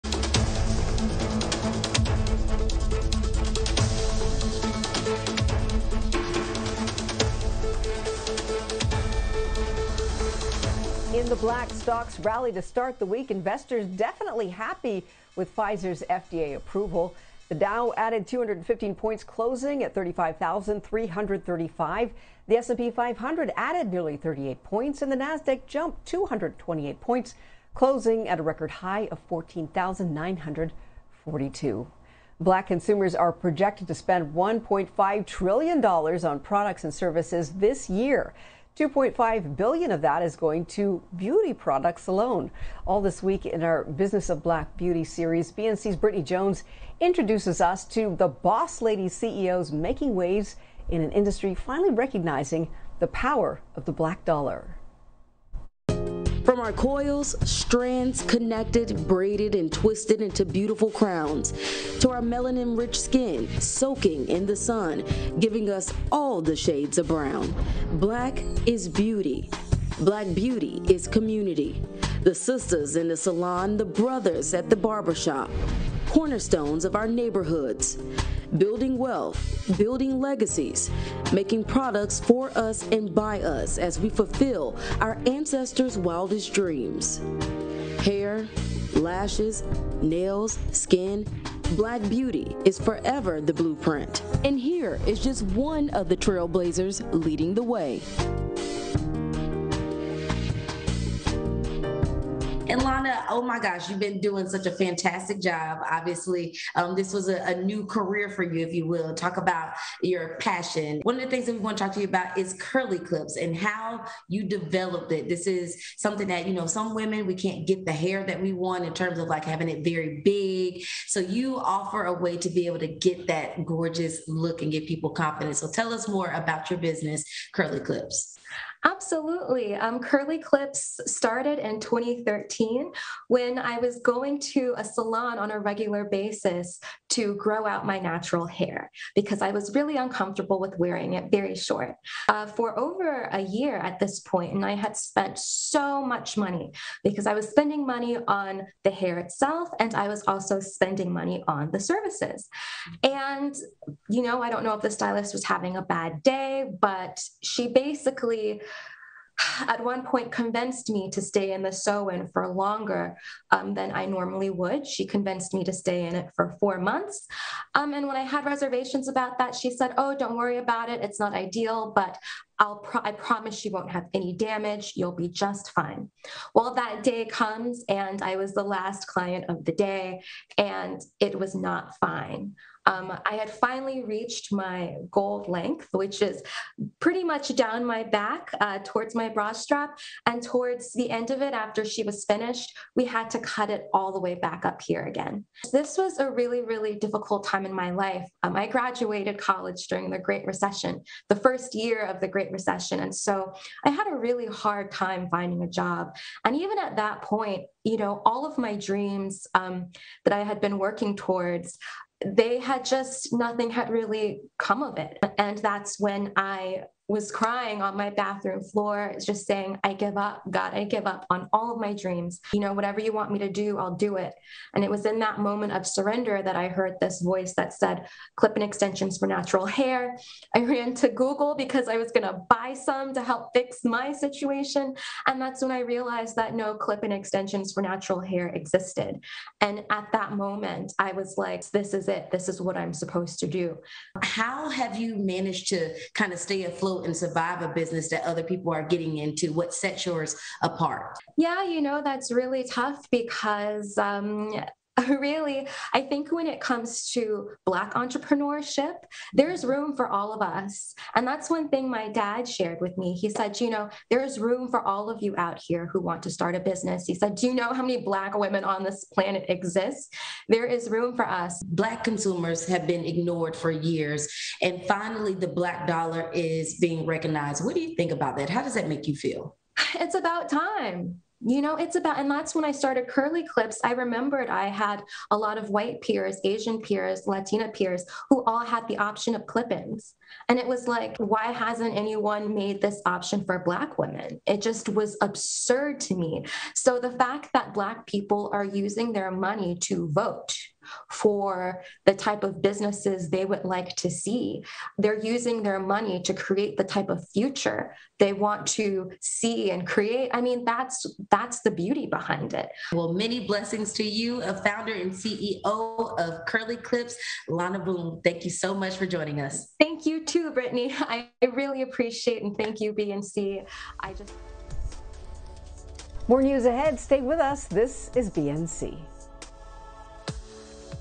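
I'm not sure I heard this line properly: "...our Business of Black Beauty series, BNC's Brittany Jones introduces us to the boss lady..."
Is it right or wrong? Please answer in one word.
right.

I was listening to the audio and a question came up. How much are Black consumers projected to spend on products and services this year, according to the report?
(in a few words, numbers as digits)
$1.5 trillion.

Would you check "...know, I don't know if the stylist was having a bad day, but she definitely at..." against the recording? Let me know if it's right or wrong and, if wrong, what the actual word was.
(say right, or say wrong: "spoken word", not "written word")
wrong: "basically", not "definitely".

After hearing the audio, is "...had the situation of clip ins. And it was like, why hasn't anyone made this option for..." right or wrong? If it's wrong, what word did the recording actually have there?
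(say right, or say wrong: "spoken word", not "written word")
wrong: "option", not "situation".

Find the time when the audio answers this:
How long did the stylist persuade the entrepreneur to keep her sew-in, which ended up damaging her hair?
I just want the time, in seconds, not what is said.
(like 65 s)
166 s.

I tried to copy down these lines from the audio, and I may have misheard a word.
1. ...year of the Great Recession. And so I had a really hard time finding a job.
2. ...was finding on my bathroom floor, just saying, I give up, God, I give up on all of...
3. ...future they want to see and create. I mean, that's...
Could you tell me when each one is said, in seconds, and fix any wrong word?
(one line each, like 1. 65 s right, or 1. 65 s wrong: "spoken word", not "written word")
1. 201 s right
2. 217 s wrong: "crying", not "finding"
3. 307 s right.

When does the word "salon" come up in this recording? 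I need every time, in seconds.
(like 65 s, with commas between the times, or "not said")
73 s, 134 s.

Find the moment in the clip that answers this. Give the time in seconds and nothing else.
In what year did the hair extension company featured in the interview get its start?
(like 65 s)
131 s.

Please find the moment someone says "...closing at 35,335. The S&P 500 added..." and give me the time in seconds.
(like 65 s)
19 s.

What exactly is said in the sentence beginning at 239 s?
And at that moment, I was like, this is it.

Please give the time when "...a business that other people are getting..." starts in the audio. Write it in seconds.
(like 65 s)
247 s.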